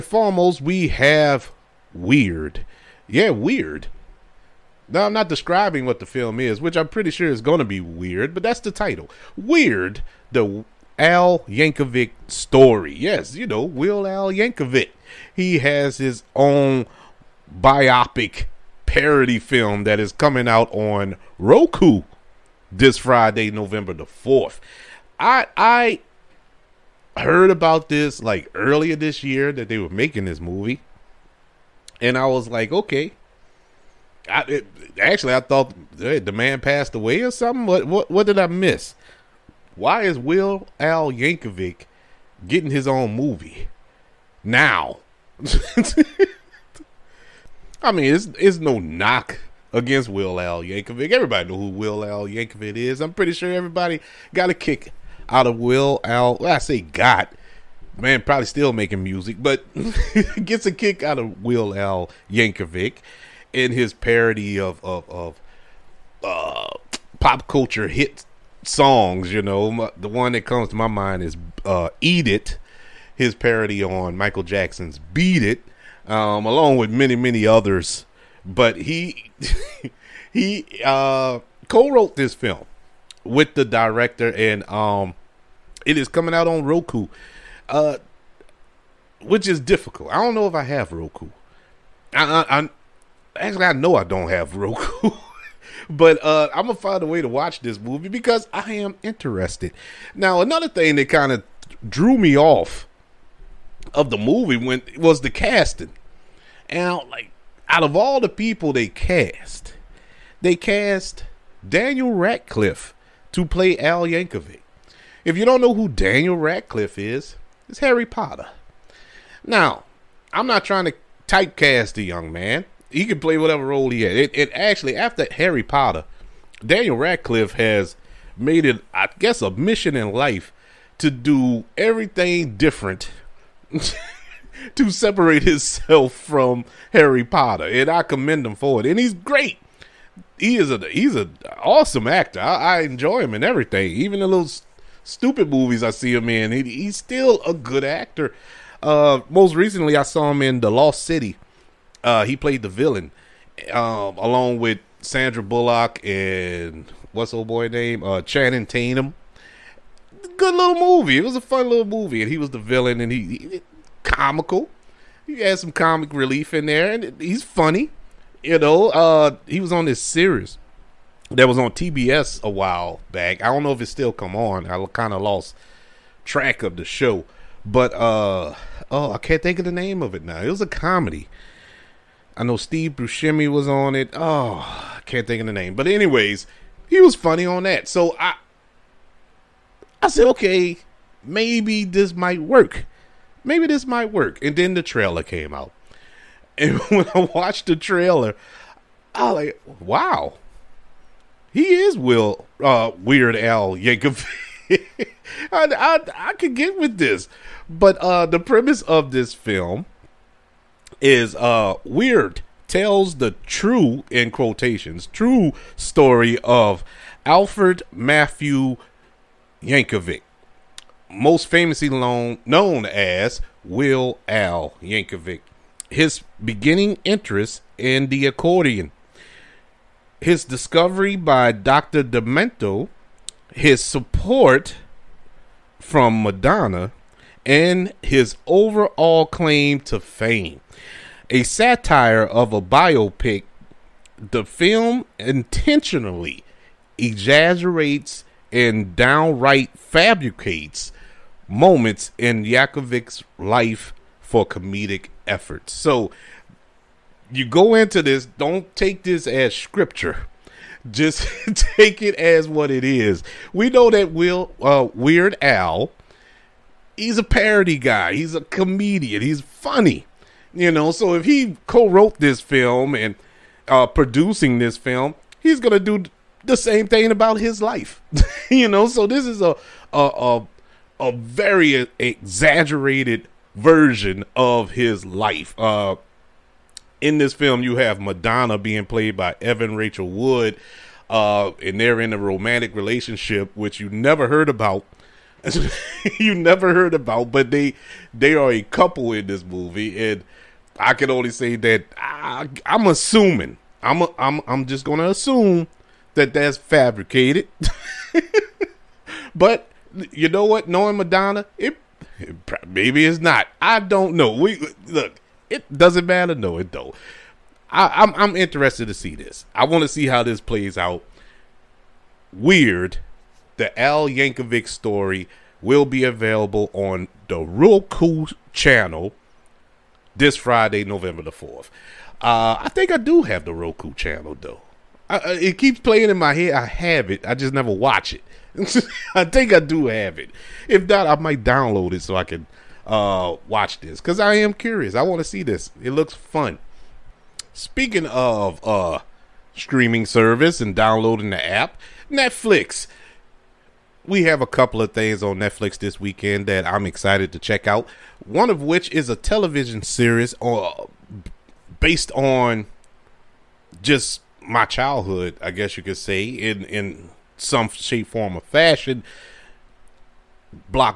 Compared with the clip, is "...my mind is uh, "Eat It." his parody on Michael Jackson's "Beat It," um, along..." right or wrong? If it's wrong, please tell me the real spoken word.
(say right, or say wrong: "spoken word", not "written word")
right.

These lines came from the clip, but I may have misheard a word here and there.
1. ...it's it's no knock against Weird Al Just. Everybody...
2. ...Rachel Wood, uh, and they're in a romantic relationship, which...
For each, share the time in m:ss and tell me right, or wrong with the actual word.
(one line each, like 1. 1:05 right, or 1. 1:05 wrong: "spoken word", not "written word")
1. 0:48 wrong: "Yankovic", not "Just"
2. 4:49 right.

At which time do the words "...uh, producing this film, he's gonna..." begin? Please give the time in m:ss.
4:33.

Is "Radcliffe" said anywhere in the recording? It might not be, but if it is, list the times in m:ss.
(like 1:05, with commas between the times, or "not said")
1:52, 1:56, 2:06.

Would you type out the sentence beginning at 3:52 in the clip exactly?
Demento, his support from Madonna, and his overall claim to fame.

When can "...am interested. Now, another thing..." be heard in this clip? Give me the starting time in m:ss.
1:38.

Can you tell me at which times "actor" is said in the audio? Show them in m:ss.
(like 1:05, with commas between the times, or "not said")
2:22, 2:27.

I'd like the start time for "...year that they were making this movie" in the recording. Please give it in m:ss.
0:29.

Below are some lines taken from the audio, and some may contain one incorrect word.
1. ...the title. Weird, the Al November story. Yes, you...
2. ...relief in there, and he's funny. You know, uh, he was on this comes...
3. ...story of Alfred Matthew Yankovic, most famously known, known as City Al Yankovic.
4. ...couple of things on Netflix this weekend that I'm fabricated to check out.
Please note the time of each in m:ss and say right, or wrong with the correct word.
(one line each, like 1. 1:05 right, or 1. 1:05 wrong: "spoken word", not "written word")
1. 0:08 wrong: "Yankovic", not "November"
2. 2:46 wrong: "series", not "comes"
3. 3:35 wrong: "Weird", not "City"
4. 5:54 wrong: "excited", not "fabricated".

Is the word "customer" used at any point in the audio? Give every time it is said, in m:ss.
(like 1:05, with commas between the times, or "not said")
not said.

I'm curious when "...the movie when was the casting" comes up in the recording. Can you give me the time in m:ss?
1:44.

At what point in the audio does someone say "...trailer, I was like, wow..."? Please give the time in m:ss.
3:17.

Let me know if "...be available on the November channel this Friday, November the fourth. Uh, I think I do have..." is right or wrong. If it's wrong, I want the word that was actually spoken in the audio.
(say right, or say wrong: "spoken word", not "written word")
wrong: "Roku", not "November".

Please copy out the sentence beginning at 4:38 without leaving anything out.
So this is a a, a a very exaggerated version of his life.